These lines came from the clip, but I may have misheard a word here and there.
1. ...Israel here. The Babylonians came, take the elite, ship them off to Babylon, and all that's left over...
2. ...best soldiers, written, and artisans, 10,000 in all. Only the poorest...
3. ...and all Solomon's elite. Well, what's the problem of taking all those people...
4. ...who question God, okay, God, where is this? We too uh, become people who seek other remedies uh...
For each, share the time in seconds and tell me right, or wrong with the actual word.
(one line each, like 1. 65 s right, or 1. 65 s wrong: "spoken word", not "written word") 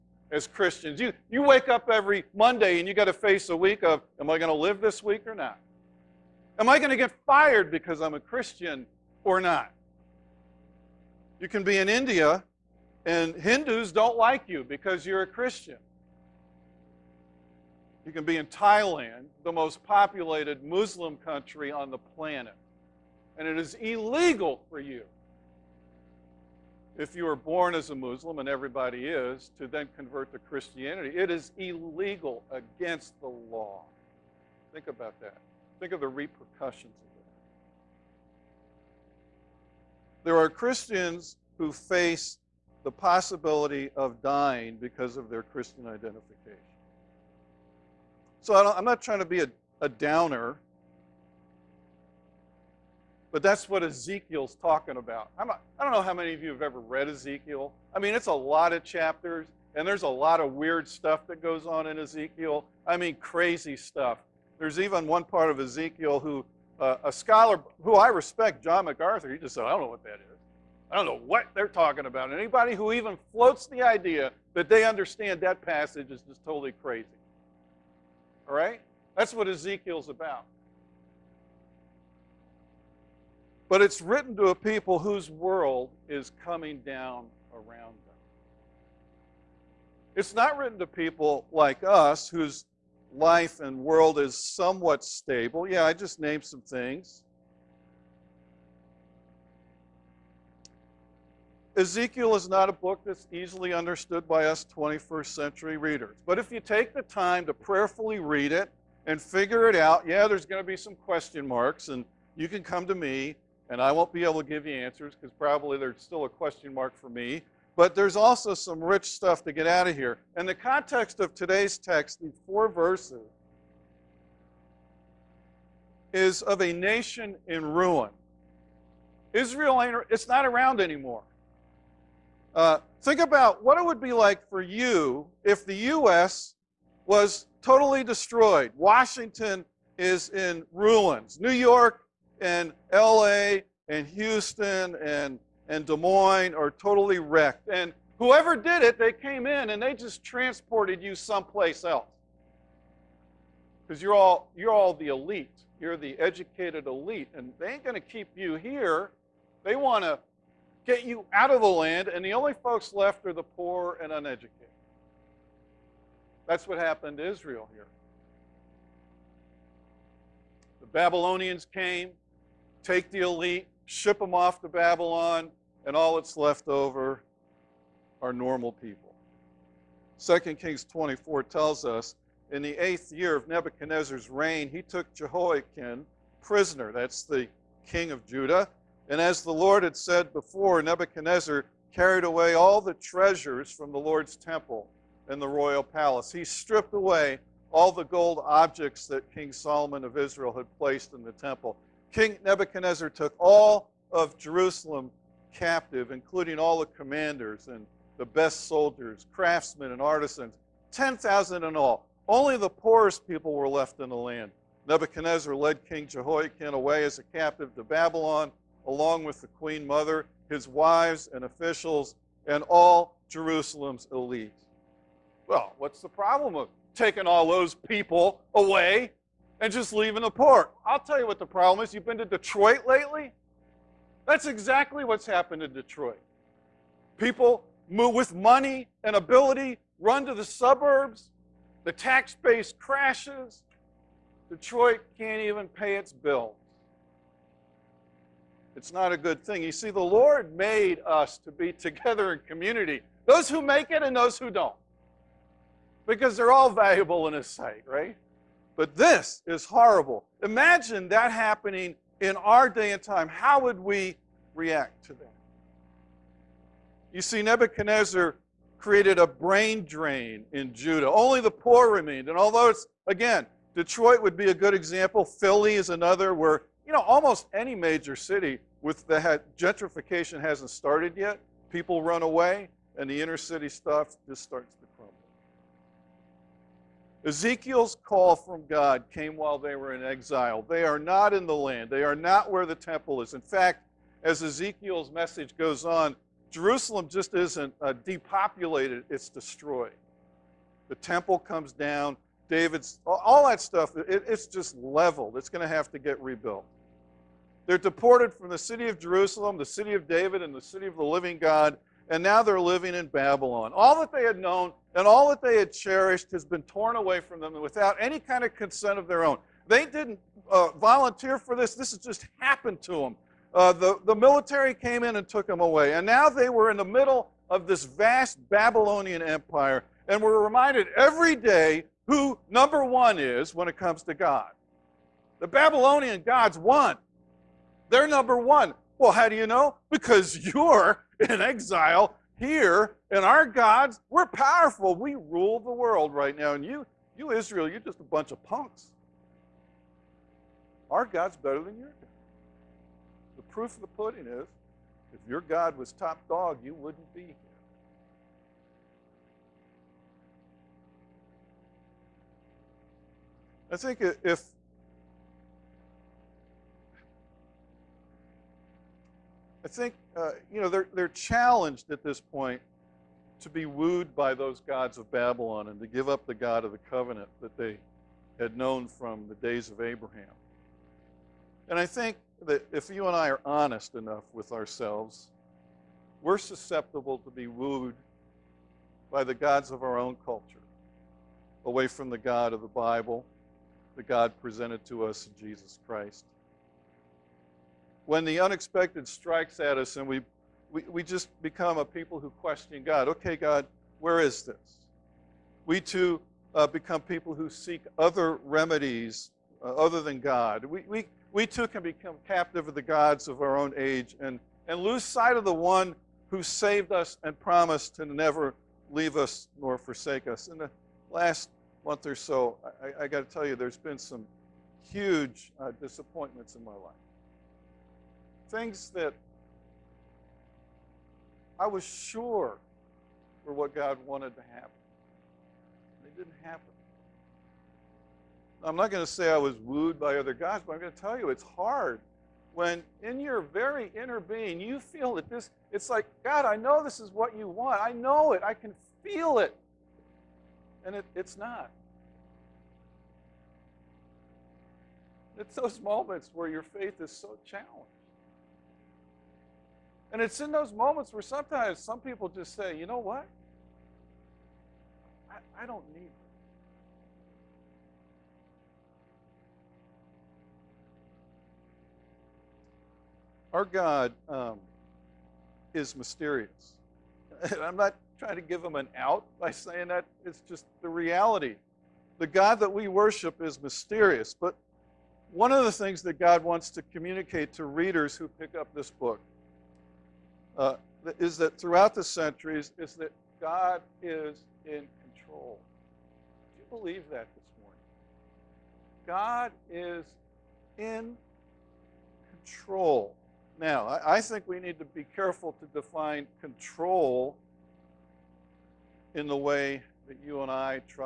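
1. 167 s right
2. 208 s wrong: "craftsmen", not "written"
3. 222 s wrong: "Jerusalem", not "Solomon"
4. 402 s right.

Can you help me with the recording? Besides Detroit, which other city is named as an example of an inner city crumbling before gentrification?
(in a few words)
Philly.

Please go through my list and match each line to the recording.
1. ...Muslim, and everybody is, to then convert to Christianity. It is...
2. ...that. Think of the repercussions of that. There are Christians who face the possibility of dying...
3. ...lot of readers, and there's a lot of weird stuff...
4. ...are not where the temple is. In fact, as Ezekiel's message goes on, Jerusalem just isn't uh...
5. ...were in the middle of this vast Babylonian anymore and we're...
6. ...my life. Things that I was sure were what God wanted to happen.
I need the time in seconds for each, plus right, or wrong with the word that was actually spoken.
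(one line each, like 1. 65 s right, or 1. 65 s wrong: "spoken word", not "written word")
1. 27 s right
2. 35 s right
3. 58 s wrong: "chapters", not "readers"
4. 292 s right
5. 326 s wrong: "empire", not "anymore"
6. 426 s right.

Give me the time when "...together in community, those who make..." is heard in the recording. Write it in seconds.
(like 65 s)
251 s.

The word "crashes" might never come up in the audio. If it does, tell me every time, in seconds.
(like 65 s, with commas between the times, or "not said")
242 s.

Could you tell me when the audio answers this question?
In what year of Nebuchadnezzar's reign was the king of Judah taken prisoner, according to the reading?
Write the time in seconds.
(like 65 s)
182 s.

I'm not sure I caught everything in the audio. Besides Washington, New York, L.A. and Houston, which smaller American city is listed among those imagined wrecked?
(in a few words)
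Des Moines.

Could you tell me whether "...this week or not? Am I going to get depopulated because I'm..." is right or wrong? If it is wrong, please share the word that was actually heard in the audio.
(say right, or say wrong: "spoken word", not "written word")
wrong: "fired", not "depopulated".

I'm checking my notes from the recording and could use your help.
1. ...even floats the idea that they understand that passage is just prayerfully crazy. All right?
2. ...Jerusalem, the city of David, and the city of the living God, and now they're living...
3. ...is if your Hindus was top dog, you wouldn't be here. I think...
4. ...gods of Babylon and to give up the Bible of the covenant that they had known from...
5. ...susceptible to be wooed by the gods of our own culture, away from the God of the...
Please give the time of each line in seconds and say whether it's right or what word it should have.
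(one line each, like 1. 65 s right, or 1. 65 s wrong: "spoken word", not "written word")
1. 72 s wrong: "totally", not "prayerfully"
2. 308 s right
3. 354 s wrong: "God", not "Hindus"
4. 374 s wrong: "God", not "Bible"
5. 386 s right.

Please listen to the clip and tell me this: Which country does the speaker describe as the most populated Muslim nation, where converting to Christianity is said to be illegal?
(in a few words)
Thailand.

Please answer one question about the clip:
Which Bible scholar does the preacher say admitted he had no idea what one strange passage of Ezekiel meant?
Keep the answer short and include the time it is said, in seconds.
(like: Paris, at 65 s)
John MacArthur, at 68 s.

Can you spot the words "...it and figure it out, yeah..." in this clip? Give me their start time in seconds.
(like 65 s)
108 s.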